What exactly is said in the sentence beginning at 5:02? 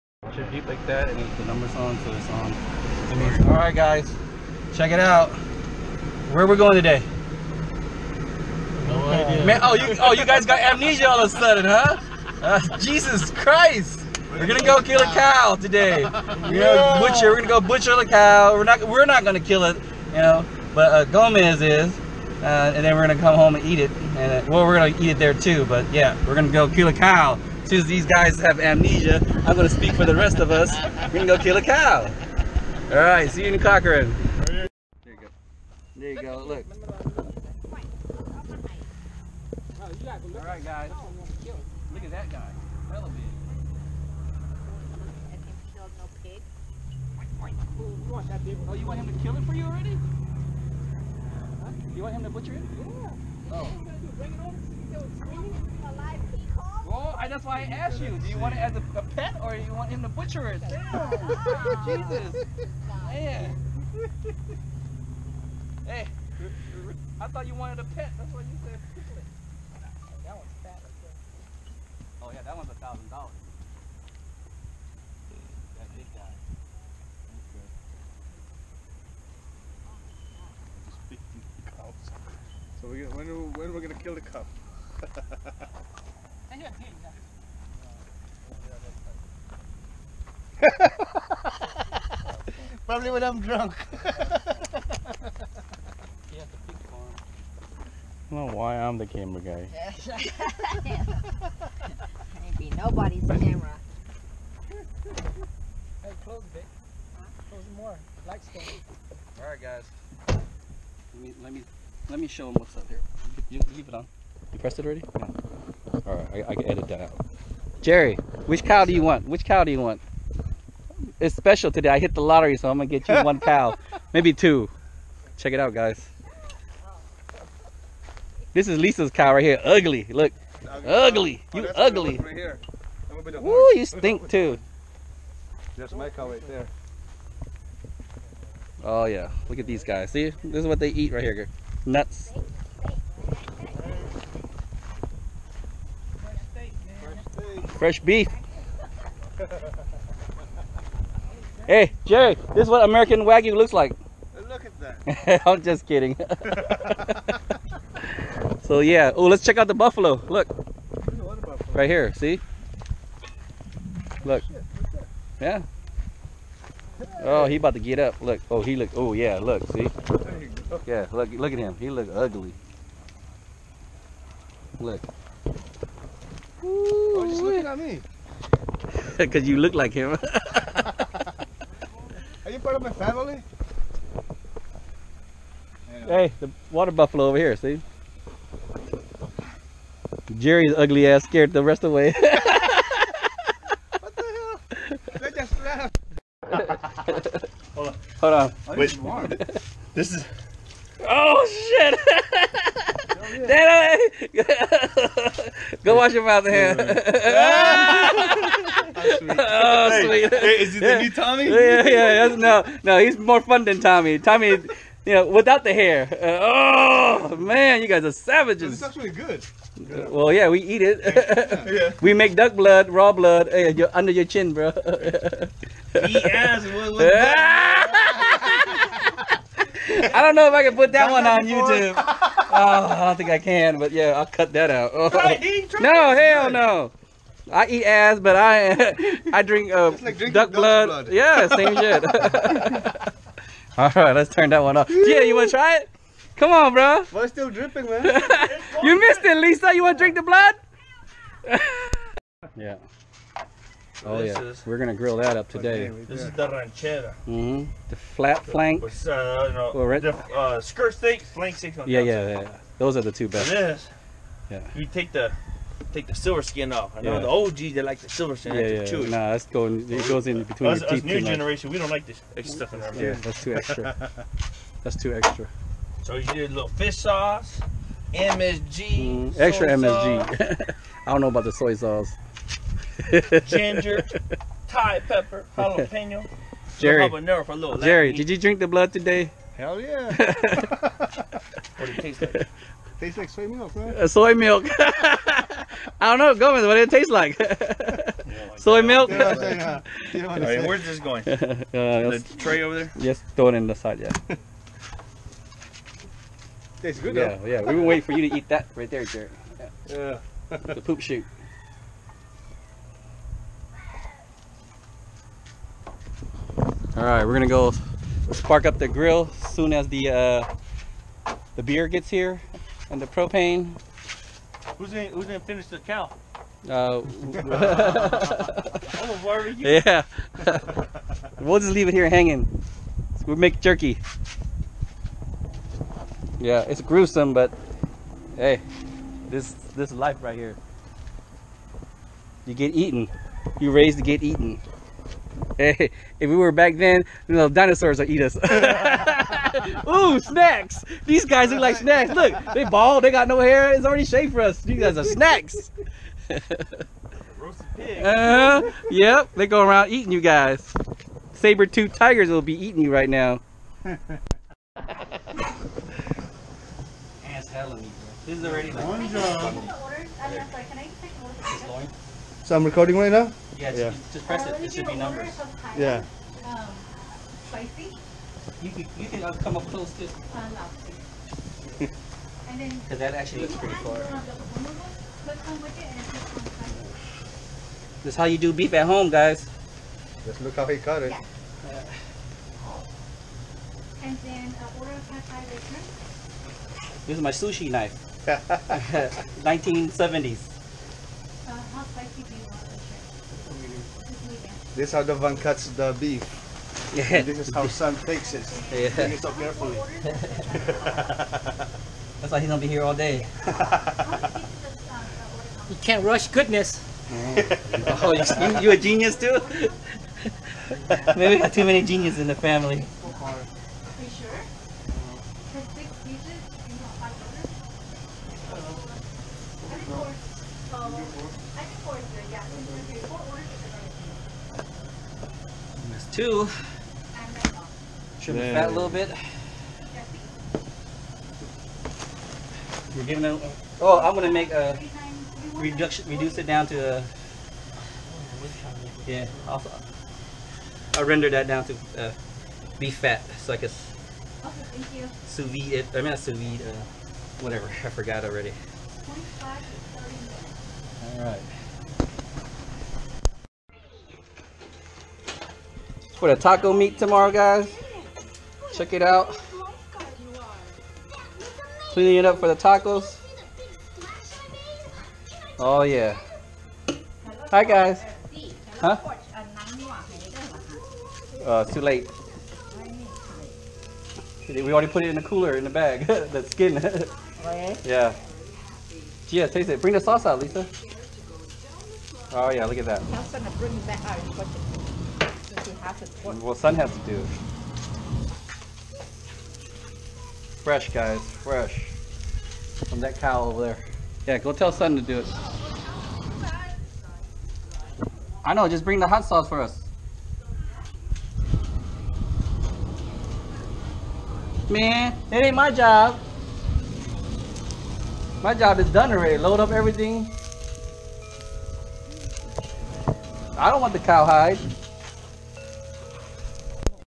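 Just throw it in the side, yeah.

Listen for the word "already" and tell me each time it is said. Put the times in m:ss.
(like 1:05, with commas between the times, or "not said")
0:49, 1:54, 5:53, 6:08, 7:38, 8:04, 8:39.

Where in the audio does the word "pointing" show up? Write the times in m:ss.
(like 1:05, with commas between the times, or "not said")
not said.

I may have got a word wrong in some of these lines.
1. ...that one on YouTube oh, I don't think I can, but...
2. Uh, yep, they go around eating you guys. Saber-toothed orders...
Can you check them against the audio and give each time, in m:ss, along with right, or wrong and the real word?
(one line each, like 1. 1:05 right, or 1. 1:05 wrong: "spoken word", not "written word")
1. 3:50 right
2. 5:58 wrong: "tigers", not "orders".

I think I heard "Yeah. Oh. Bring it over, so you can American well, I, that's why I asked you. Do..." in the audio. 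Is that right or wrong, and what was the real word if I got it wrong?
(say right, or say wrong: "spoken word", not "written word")
wrong: "Alive", not "American".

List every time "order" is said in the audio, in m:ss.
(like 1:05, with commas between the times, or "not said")
6:34, 7:13.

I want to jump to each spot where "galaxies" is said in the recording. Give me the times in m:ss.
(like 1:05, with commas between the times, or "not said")
not said.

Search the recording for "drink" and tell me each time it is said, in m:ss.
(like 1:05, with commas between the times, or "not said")
3:59, 4:10, 4:48.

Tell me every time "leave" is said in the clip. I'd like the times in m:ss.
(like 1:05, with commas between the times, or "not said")
1:53, 5:31.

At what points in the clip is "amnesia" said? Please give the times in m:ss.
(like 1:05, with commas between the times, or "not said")
0:10, 0:28.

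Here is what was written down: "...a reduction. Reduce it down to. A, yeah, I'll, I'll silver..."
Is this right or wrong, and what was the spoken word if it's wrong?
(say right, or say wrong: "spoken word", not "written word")
wrong: "render", not "silver".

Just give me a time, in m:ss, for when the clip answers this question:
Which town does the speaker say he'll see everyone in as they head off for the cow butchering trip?
0:33.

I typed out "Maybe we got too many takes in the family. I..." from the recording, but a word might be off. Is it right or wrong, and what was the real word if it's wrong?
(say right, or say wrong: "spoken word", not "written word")
wrong: "geniuses", not "takes".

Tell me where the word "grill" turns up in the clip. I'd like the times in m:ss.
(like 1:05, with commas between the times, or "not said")
4:14, 5:18.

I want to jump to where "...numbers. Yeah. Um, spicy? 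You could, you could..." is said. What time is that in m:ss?
6:14.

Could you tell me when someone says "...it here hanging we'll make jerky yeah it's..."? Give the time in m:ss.
5:31.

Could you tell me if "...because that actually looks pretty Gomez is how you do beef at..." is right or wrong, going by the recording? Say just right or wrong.
wrong.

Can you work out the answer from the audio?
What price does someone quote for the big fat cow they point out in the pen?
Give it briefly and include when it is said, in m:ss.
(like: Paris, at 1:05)
$1,000, at 1:12.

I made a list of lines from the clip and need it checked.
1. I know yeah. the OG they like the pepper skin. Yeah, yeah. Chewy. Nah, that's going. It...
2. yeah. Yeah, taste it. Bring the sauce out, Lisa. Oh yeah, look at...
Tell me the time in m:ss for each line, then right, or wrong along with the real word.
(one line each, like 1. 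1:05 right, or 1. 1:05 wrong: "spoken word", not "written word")
1. 4:26 wrong: "silver", not "pepper"
2. 8:07 right.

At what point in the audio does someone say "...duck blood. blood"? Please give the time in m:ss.
4:00.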